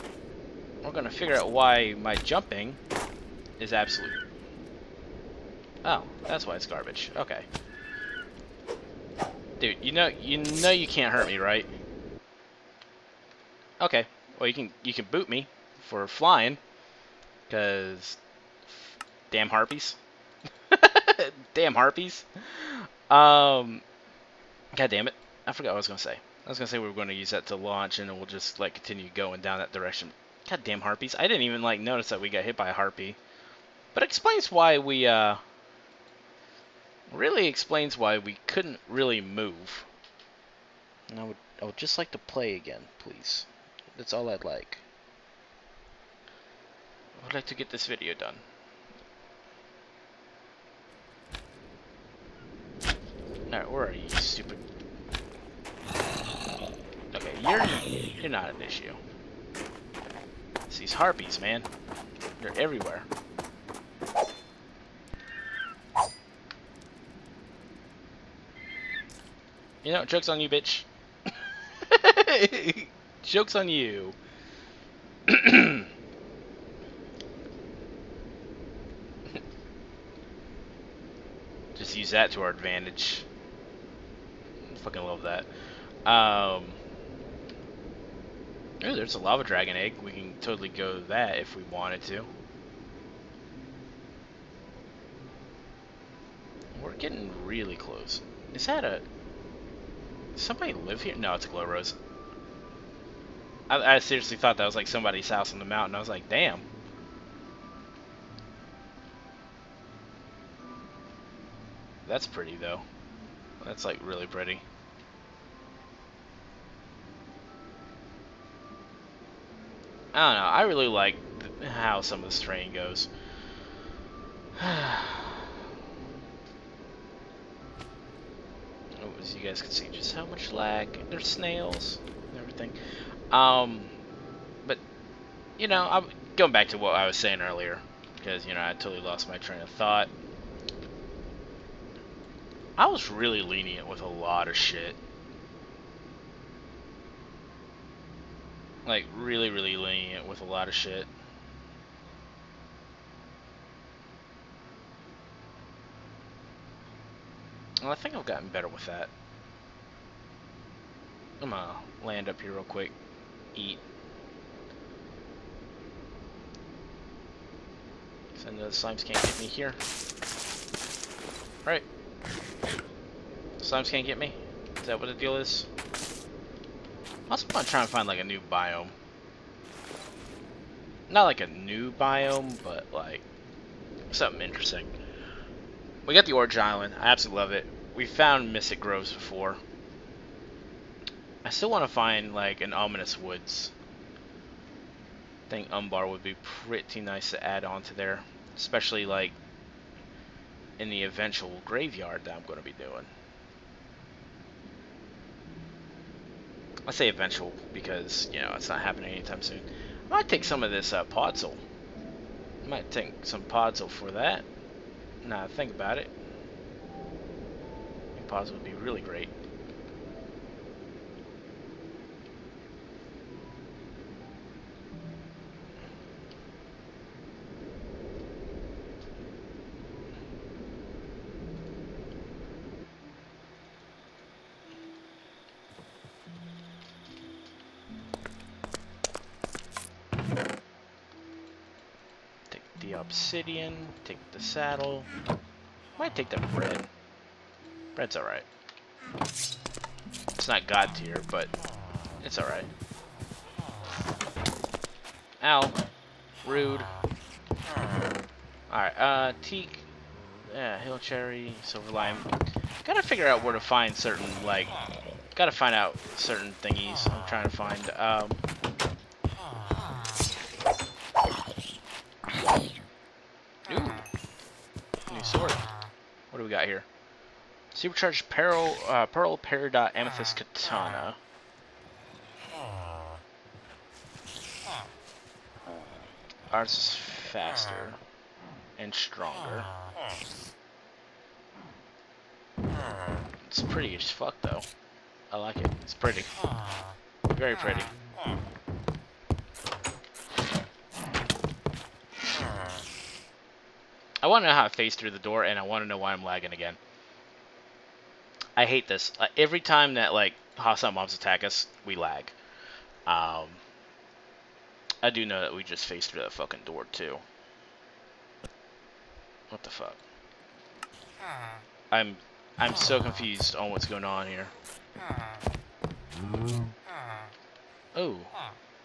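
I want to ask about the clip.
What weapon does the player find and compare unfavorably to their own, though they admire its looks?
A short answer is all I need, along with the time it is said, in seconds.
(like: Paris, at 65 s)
Katana, at 280 s.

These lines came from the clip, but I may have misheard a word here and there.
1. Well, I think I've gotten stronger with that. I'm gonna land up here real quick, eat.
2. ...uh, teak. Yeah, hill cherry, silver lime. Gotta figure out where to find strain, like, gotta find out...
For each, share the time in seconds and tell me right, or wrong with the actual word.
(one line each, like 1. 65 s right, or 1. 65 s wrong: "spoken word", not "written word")
1. 157 s wrong: "better", not "stronger"
2. 258 s wrong: "certain", not "strain".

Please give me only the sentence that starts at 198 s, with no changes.
Especially like in the eventual graveyard that I'm going to be doing.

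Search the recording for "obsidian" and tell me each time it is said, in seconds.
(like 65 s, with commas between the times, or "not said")
243 s.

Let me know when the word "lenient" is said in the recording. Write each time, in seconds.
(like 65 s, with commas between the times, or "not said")
143 s, 149 s.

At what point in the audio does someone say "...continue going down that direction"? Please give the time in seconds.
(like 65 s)
28 s.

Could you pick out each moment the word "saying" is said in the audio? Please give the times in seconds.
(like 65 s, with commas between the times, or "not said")
137 s.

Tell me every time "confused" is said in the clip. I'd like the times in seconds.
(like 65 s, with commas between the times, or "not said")
323 s.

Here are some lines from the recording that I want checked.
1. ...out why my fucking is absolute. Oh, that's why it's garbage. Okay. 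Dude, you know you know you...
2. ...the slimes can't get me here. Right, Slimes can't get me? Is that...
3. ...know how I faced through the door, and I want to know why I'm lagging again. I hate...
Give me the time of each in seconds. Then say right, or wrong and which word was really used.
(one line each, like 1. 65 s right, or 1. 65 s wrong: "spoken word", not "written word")
1. 1 s wrong: "jumping", not "fucking"
2. 168 s right
3. 304 s right.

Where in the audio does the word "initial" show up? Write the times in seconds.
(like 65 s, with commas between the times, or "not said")
not said.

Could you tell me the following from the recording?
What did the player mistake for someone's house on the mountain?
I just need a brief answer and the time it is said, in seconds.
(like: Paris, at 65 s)
A glow rose, at 101 s.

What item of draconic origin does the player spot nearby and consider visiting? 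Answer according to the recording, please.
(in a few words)
Lava dragon egg.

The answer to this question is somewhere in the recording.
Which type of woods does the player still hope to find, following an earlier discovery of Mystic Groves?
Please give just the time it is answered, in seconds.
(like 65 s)
192 s.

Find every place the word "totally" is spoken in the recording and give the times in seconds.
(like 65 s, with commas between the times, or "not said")
90 s, 138 s.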